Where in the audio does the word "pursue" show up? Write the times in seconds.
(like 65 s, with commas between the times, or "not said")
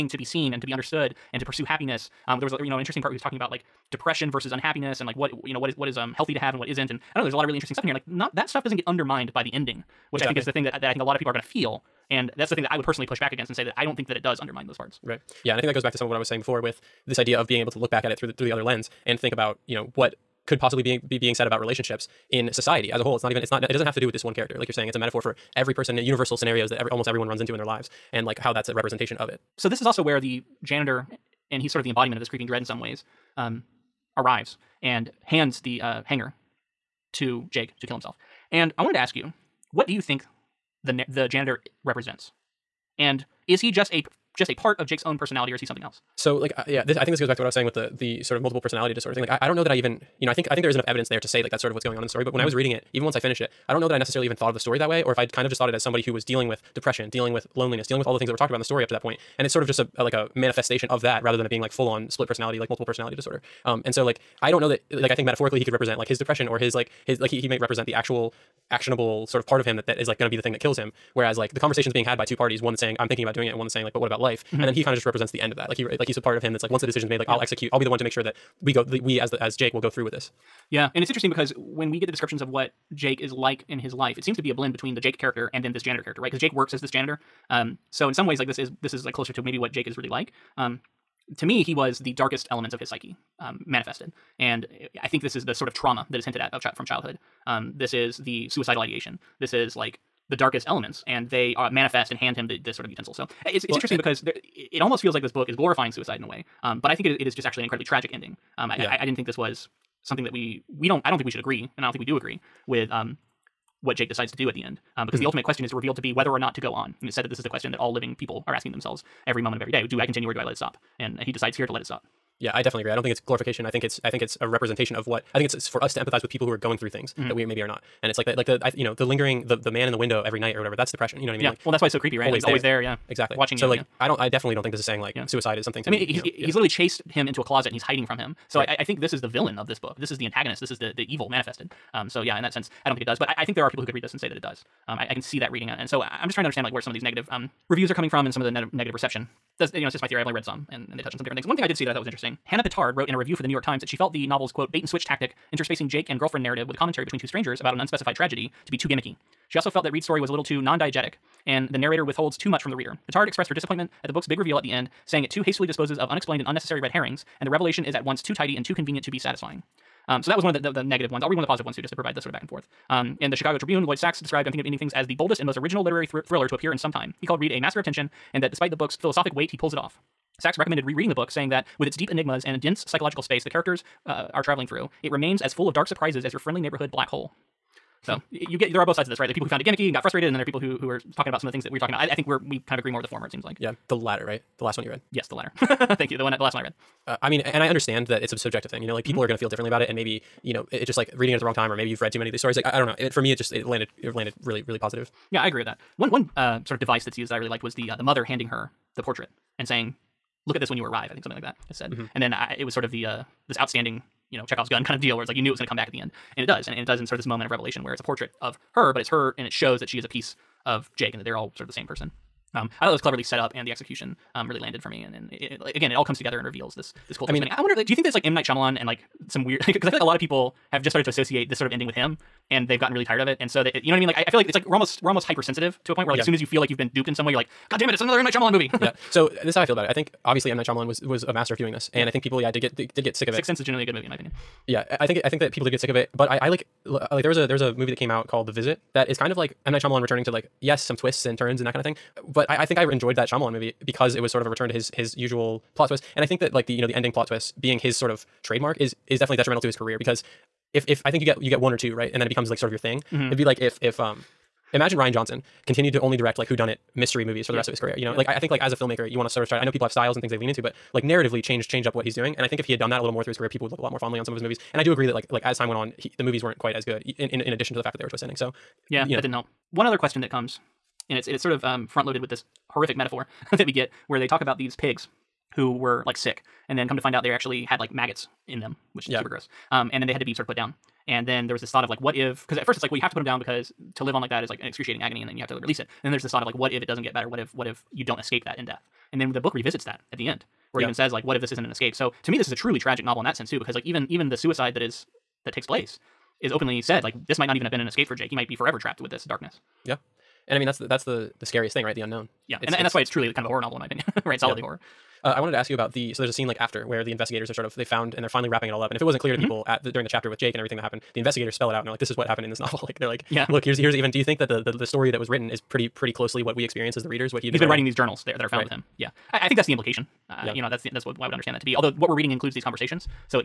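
1 s.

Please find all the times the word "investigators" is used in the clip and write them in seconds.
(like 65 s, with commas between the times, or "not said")
317 s, 321 s.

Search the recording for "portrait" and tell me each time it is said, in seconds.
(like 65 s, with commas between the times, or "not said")
209 s, 218 s.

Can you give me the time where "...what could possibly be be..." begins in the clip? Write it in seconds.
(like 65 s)
19 s.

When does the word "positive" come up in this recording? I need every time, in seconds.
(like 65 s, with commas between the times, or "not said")
171 s, 204 s.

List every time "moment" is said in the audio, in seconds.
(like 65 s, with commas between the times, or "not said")
119 s, 217 s.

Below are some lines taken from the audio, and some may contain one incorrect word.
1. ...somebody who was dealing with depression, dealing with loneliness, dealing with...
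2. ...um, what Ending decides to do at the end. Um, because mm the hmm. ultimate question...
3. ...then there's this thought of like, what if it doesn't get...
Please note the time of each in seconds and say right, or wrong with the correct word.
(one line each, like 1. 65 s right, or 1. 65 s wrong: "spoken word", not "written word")
1. 55 s right
2. 112 s wrong: "Jake", not "Ending"
3. 296 s right.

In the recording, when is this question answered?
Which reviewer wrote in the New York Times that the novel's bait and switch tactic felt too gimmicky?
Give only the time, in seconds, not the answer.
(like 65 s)
152 s.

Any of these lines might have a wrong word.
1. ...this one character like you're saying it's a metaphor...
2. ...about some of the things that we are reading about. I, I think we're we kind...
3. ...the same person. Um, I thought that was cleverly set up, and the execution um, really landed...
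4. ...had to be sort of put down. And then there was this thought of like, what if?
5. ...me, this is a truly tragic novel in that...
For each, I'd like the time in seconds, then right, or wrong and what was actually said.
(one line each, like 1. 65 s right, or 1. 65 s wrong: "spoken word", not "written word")
1. 24 s right
2. 191 s wrong: "talking", not "reading"
3. 221 s right
4. 290 s right
5. 302 s right.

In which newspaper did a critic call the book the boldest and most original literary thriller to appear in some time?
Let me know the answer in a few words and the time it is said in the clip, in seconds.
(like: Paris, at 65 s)
Chicago Tribune, at 173 s.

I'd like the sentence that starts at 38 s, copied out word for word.
And I wanted to ask you, what do you think the the janitor represents?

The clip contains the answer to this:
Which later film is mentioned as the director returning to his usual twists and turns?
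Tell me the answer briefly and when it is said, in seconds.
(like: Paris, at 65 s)
The Visit, at 248 s.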